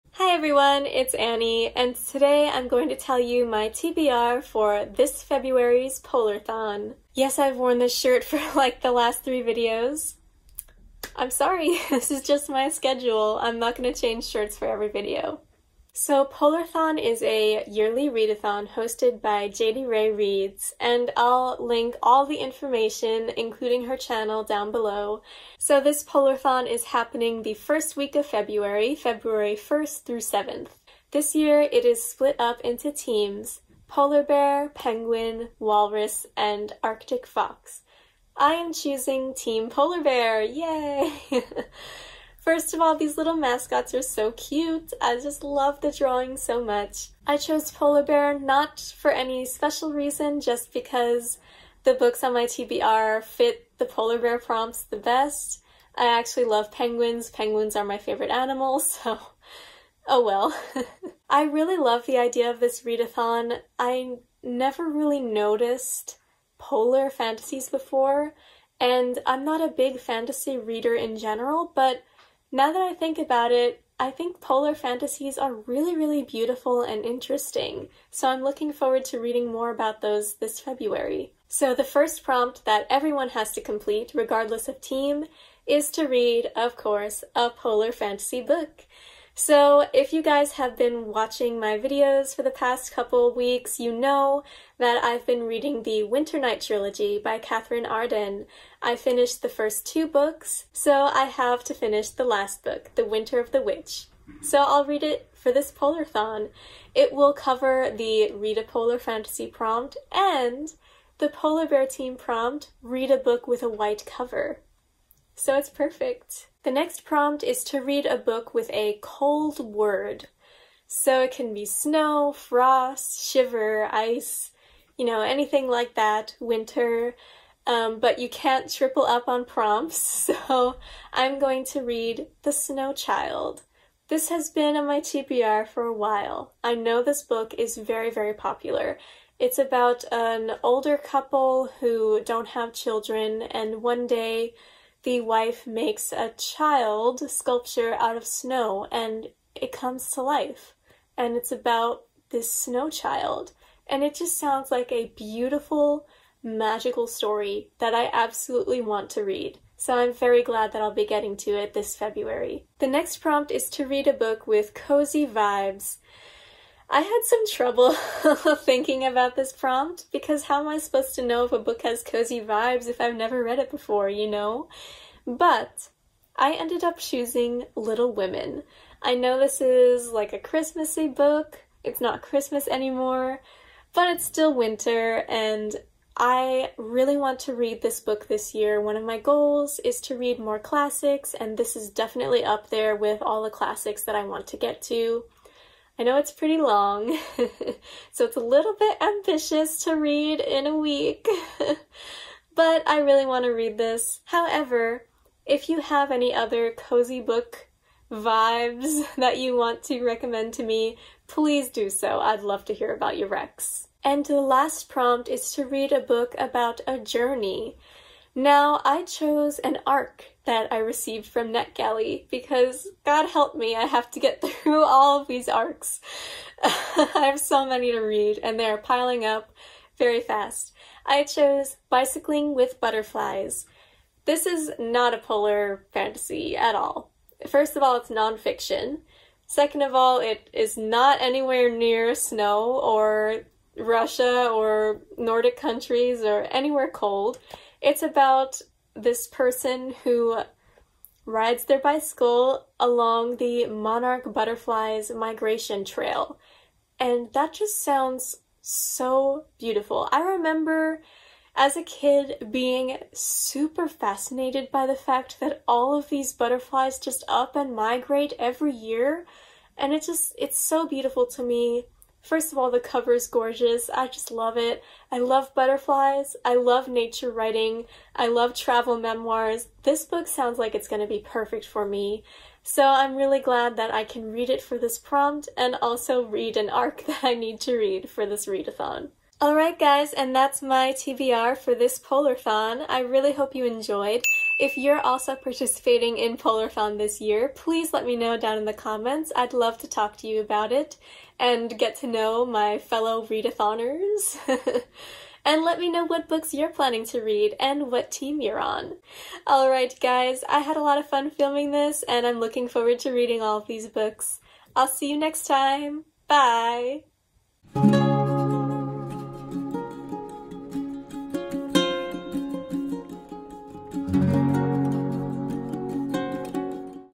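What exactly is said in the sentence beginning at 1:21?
So the first prompt that everyone has to complete, regardless of team, is to read, of course, a polar fantasy book.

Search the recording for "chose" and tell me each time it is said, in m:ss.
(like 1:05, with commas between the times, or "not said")
0:47, 3:39, 3:51.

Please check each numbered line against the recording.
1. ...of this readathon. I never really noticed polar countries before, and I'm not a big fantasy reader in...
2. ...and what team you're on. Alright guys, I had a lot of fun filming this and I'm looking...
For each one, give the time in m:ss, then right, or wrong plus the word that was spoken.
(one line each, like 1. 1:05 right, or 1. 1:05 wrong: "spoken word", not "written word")
1. 1:02 wrong: "fantasies", not "countries"
2. 5:07 right.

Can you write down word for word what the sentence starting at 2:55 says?
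But I ended up choosing Little Women.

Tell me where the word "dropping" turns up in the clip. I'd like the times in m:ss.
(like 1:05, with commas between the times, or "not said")
not said.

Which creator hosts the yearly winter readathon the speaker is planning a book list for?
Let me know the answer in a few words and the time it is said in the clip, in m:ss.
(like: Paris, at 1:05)
Jadeyrae Reads, at 0:19.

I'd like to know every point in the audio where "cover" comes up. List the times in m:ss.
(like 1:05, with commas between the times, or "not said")
1:47, 1:54, 4:32.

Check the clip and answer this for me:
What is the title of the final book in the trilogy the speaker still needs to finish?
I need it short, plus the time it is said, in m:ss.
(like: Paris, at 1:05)
The Winter of the Witch, at 1:42.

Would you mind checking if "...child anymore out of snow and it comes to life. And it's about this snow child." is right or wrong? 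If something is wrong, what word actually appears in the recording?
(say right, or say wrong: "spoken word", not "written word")
wrong: "sculpture", not "anymore".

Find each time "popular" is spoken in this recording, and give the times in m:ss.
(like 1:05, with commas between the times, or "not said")
2:18.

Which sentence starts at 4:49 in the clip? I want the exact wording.
Alright guys, and that's my TBR for this Polarthon.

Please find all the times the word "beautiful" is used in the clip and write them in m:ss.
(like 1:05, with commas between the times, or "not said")
1:16, 2:35, 4:19, 4:30.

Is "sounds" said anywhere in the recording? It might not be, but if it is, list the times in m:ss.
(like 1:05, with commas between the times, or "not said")
2:34, 4:17, 4:40.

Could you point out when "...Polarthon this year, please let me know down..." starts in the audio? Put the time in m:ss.
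4:56.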